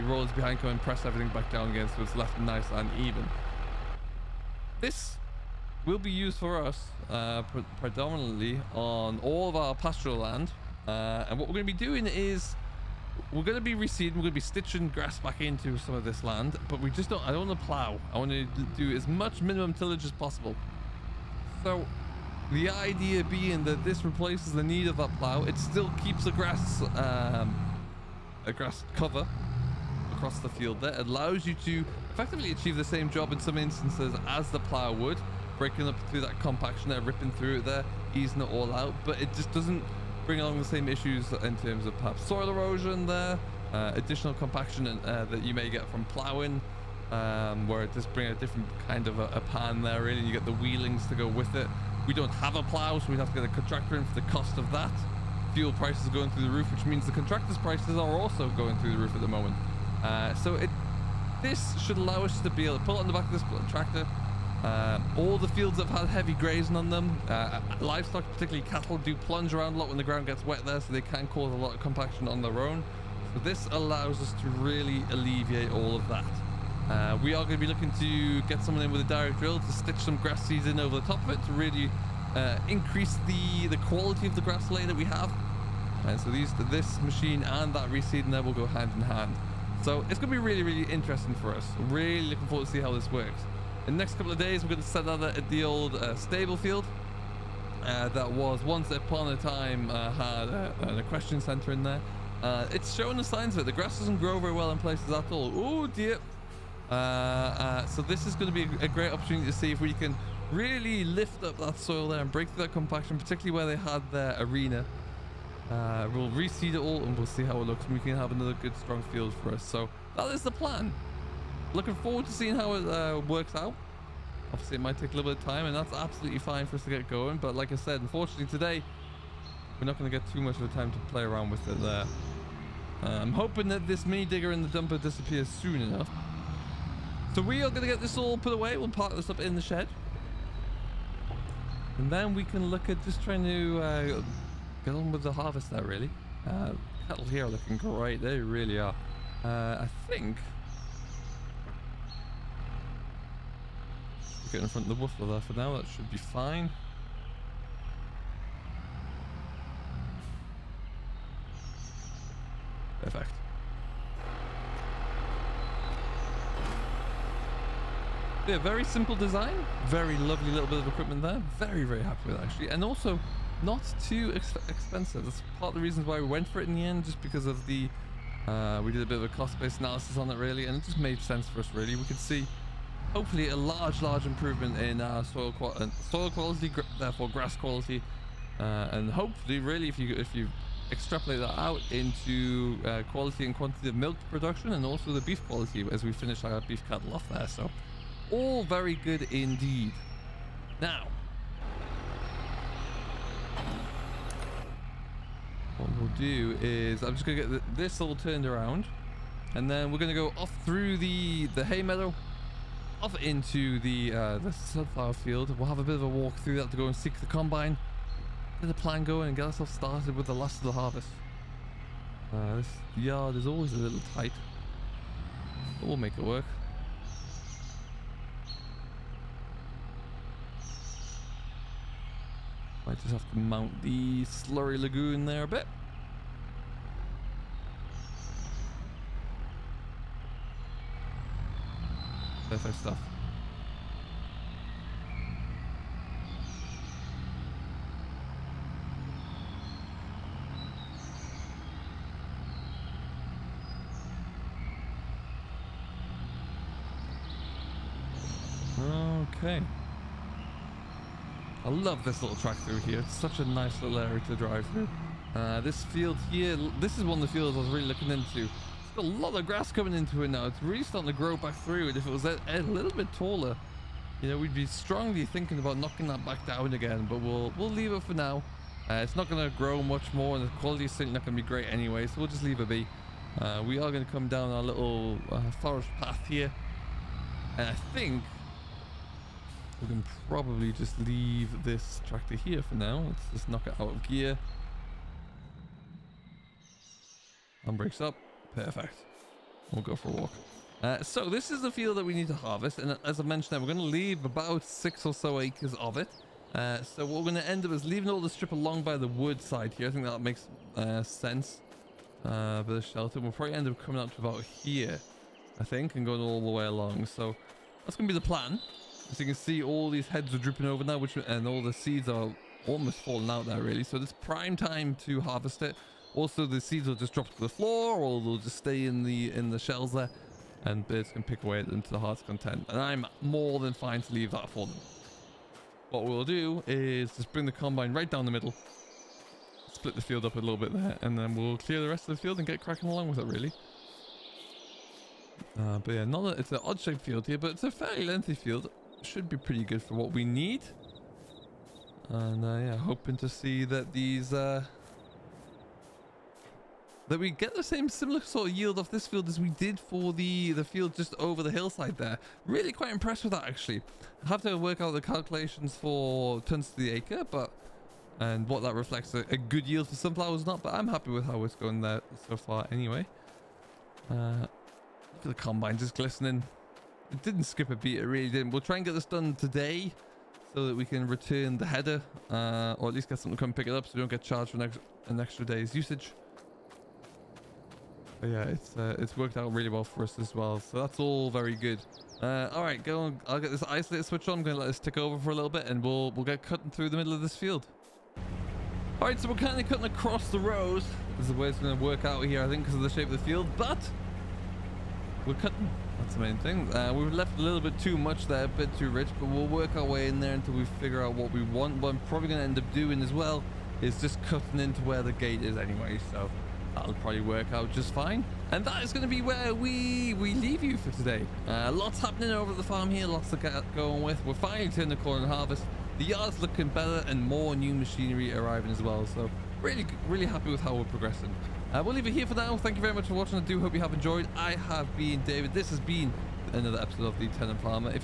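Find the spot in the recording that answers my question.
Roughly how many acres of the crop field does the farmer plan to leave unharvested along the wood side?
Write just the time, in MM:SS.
05:04.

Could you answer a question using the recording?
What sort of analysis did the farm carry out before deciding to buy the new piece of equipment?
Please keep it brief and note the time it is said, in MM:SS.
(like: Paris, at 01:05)
Cost-based analysis, at 02:59.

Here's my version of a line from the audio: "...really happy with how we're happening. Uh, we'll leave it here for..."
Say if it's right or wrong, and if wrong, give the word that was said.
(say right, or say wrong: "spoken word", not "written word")
wrong: "progressing", not "happening".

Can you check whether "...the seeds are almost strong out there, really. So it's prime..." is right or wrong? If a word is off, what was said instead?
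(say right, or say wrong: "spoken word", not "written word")
wrong: "falling", not "strong".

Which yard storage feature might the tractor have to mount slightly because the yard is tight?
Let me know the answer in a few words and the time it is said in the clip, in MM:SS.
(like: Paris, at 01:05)
The slurry lagoon, at 03:54.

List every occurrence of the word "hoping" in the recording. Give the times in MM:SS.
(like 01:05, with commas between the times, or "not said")
02:13, 05:52.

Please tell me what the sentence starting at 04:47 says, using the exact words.
And I think we can probably just leave this tractor here for now.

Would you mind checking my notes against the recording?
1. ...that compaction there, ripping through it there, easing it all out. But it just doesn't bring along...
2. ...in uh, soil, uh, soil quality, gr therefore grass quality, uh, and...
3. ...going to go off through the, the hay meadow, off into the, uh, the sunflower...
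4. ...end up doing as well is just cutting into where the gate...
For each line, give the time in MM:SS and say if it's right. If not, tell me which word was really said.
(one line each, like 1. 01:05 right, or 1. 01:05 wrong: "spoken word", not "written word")
1. 00:36 right
2. 03:04 right
3. 03:29 right
4. 06:52 right.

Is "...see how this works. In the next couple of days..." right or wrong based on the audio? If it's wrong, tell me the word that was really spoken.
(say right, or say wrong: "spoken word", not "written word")
right.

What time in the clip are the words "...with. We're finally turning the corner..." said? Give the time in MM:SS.
07:04.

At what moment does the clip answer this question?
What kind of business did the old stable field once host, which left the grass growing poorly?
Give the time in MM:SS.
01:40.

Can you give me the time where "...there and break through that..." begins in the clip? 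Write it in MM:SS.
01:52.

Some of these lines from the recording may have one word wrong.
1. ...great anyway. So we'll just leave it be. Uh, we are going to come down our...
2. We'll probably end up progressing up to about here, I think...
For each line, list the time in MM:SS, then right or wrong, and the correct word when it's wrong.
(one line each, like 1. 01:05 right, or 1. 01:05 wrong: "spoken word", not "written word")
1. 04:41 right
2. 05:13 wrong: "coming", not "progressing".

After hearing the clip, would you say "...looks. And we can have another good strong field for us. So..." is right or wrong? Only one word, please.
right.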